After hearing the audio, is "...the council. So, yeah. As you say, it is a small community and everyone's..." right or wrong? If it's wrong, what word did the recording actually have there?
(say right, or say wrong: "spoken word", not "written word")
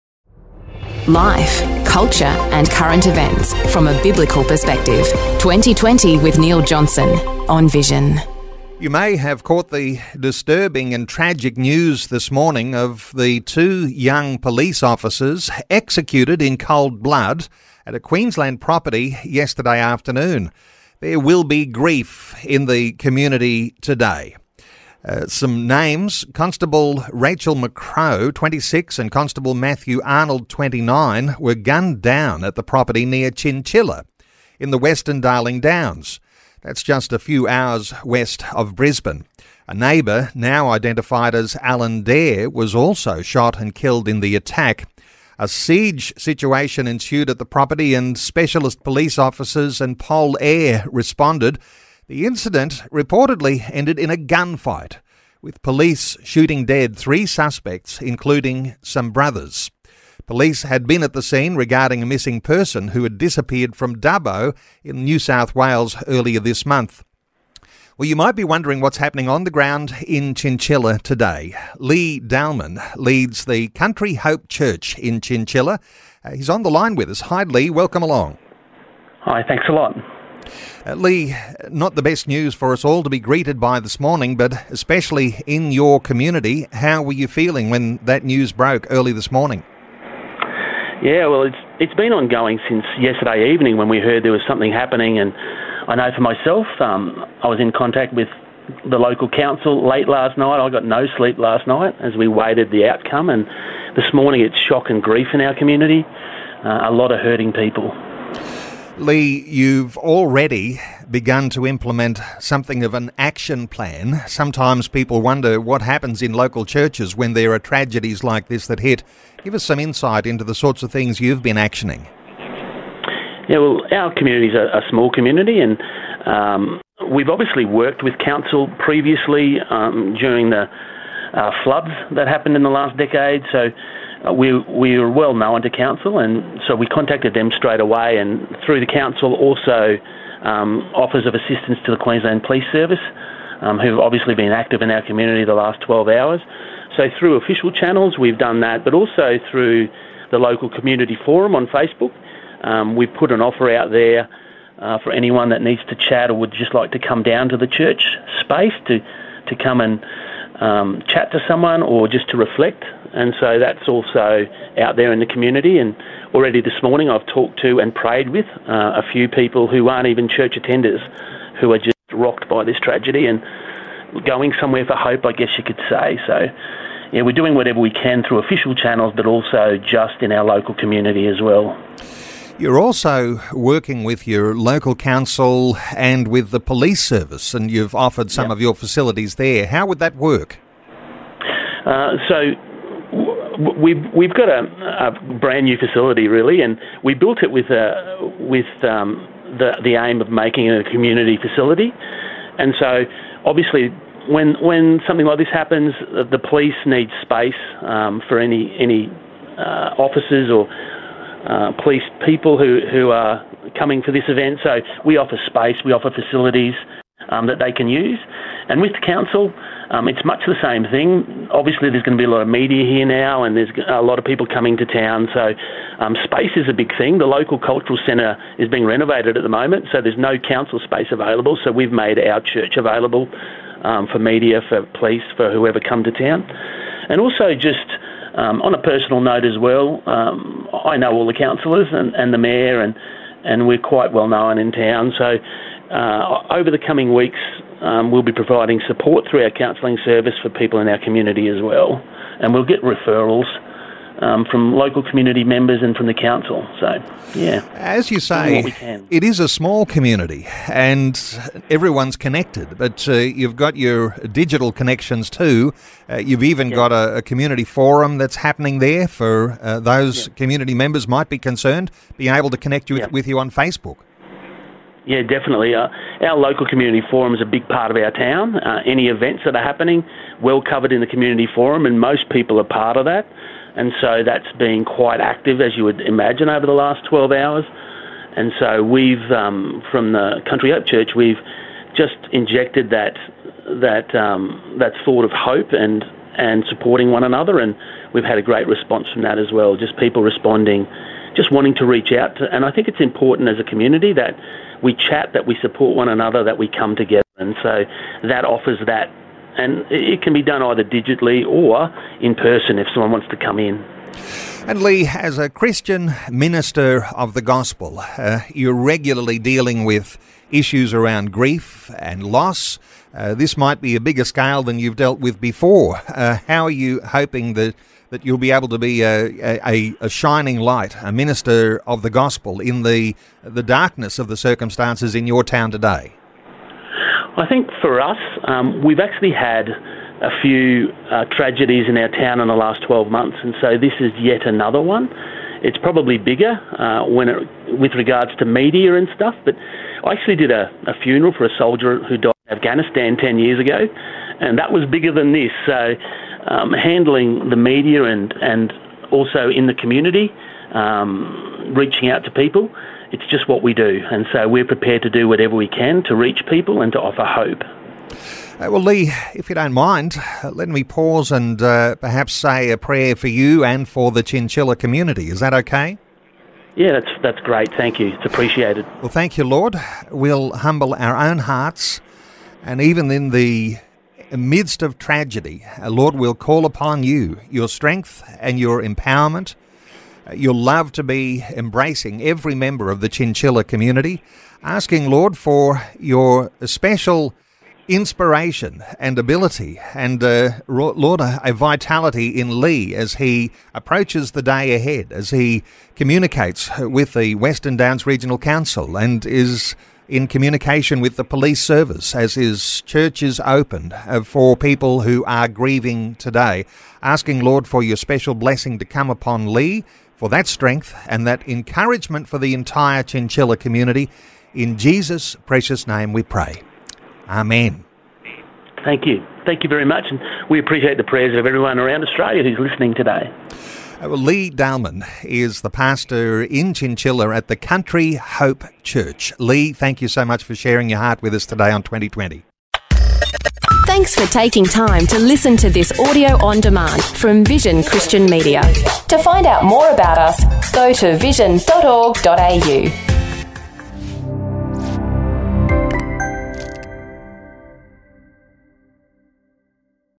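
right.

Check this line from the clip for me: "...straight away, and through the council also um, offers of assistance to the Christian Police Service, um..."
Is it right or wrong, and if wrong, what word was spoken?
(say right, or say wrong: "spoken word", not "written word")
wrong: "Queensland", not "Christian".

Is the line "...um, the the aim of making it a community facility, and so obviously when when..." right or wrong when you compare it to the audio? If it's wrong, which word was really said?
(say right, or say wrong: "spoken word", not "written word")
right.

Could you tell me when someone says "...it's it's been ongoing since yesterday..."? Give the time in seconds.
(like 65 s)
91 s.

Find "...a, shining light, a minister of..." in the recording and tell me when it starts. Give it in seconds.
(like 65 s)
330 s.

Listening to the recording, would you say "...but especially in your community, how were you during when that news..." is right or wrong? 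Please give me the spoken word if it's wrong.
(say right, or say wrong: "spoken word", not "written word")
wrong: "feeling", not "during".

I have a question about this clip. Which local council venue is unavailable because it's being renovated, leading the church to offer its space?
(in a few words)
Cultural centre.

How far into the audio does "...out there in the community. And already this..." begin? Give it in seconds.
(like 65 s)
164 s.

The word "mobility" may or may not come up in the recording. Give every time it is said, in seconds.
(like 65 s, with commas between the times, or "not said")
not said.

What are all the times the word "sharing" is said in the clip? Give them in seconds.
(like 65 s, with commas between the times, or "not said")
440 s.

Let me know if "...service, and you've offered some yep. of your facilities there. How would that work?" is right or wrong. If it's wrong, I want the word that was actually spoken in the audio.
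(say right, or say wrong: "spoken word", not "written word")
right.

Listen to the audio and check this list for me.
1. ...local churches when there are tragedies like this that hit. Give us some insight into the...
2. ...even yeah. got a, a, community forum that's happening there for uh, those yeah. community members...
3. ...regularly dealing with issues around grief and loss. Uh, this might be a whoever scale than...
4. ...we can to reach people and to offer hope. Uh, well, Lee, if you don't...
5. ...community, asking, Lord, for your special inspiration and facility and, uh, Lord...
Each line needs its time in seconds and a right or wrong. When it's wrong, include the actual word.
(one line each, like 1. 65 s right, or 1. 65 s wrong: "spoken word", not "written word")
1. 116 s right
2. 266 s right
3. 318 s wrong: "bigger", not "whoever"
4. 365 s right
5. 393 s wrong: "ability", not "facility".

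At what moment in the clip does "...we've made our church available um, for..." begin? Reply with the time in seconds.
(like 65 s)
231 s.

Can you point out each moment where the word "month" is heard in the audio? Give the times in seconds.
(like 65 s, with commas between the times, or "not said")
66 s, 343 s.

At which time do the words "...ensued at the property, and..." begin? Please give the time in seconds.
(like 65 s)
46 s.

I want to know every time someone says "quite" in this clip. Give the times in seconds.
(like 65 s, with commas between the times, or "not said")
243 s, 284 s.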